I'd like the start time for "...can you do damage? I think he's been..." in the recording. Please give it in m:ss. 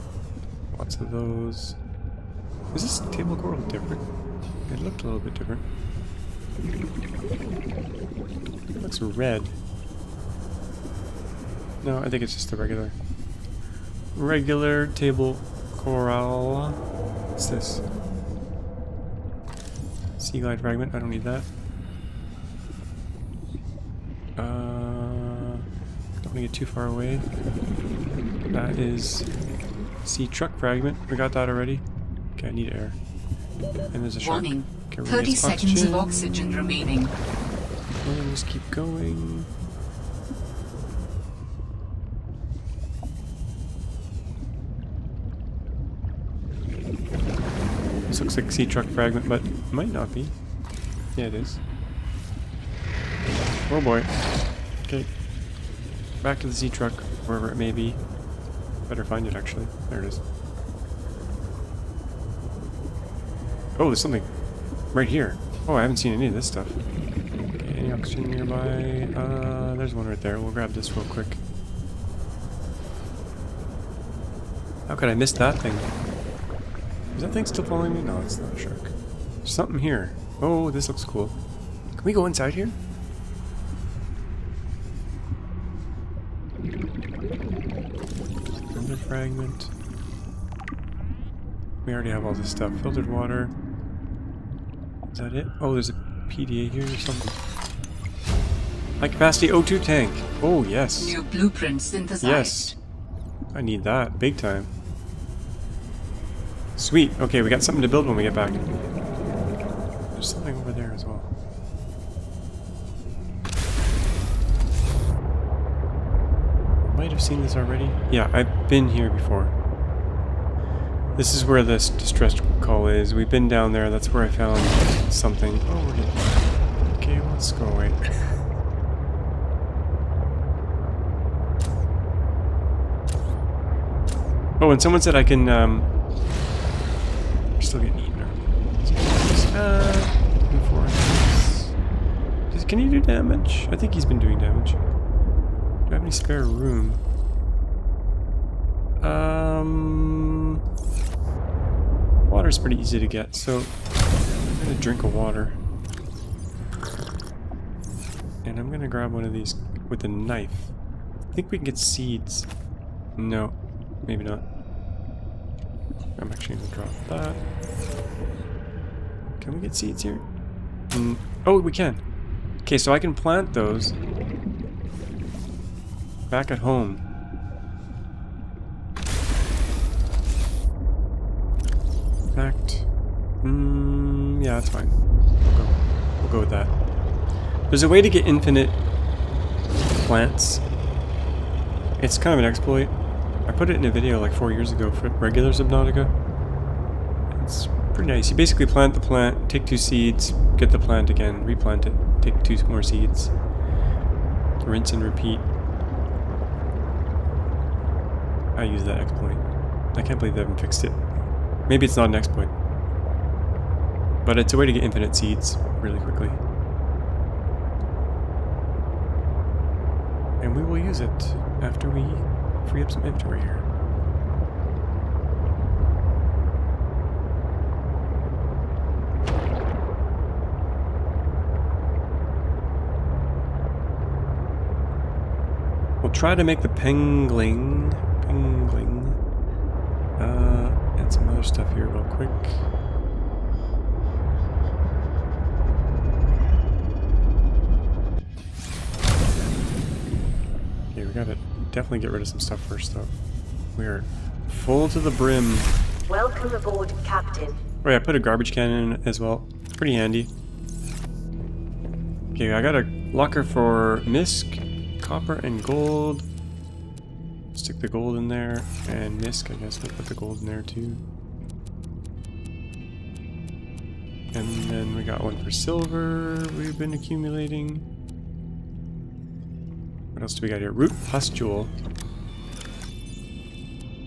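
2:22.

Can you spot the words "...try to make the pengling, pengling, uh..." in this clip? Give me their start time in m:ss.
3:56.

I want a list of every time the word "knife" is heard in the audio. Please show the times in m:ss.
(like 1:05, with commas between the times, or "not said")
2:40.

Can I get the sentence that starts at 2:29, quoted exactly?
Um, water's pretty easy to get, so I'm gonna drink a water.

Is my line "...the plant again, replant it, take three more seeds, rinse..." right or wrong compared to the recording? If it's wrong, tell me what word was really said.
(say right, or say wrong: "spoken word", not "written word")
wrong: "two", not "three".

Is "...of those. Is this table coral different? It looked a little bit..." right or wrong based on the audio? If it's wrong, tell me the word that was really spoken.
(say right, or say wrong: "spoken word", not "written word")
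right.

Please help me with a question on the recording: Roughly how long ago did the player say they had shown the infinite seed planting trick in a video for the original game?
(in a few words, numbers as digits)
4 years.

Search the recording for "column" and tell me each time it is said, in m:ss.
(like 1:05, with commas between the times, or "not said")
not said.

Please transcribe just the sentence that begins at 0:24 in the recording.
Uh, don't want to get too far away.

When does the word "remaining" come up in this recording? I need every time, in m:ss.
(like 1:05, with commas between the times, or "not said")
0:36.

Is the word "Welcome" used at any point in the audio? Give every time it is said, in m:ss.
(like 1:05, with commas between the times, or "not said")
4:16.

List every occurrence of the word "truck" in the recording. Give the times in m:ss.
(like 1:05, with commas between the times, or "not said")
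0:30, 0:48, 0:56.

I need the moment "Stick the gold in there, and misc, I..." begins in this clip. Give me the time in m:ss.
4:27.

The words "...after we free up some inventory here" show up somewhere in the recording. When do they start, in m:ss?
3:41.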